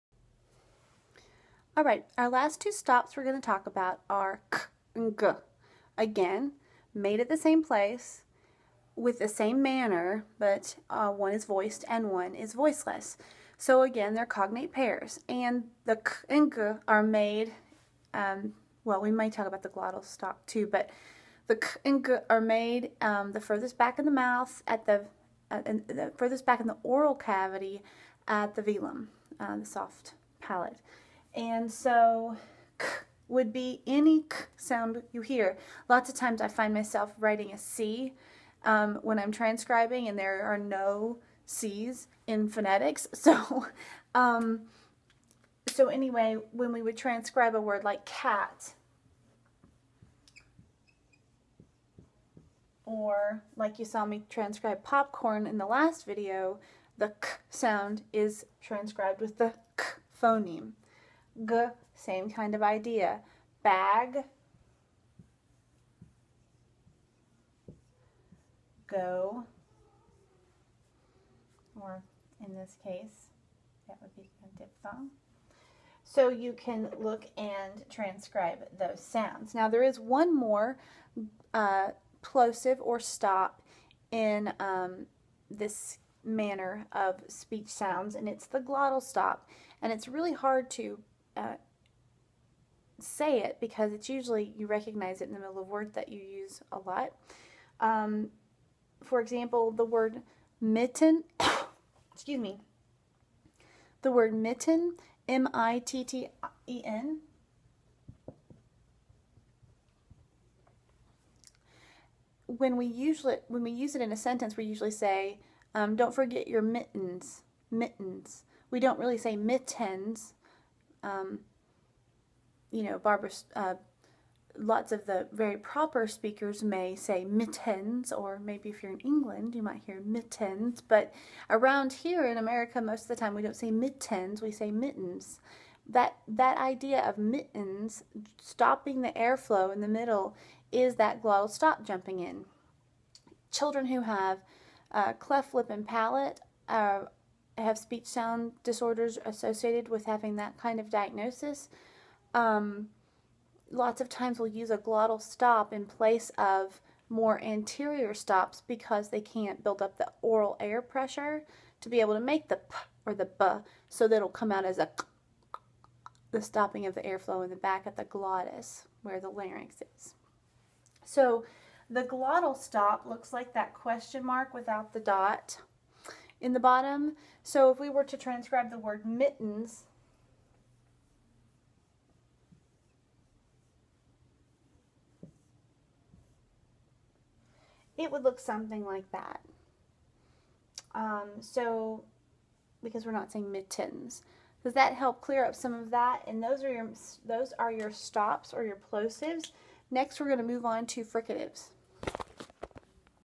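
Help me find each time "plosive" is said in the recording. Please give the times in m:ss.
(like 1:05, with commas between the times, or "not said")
1:22, 3:18.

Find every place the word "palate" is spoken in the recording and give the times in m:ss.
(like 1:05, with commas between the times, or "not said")
0:30, 2:25.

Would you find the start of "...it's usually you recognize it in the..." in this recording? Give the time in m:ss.
1:33.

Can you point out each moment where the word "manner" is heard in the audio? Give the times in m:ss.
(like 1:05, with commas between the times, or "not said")
0:09, 1:26.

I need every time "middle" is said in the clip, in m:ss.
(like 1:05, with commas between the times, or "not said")
1:35, 2:19.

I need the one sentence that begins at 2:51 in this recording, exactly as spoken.
So the glottal stop looks like that question mark without the dot in the bottom.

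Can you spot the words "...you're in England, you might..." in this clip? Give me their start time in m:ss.
2:08.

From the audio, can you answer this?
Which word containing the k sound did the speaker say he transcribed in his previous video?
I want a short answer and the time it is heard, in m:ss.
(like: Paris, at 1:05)
popcorn, at 0:54.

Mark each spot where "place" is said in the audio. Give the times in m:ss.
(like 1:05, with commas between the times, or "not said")
0:07, 2:35.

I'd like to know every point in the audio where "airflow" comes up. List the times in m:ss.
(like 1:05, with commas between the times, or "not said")
2:19, 2:47.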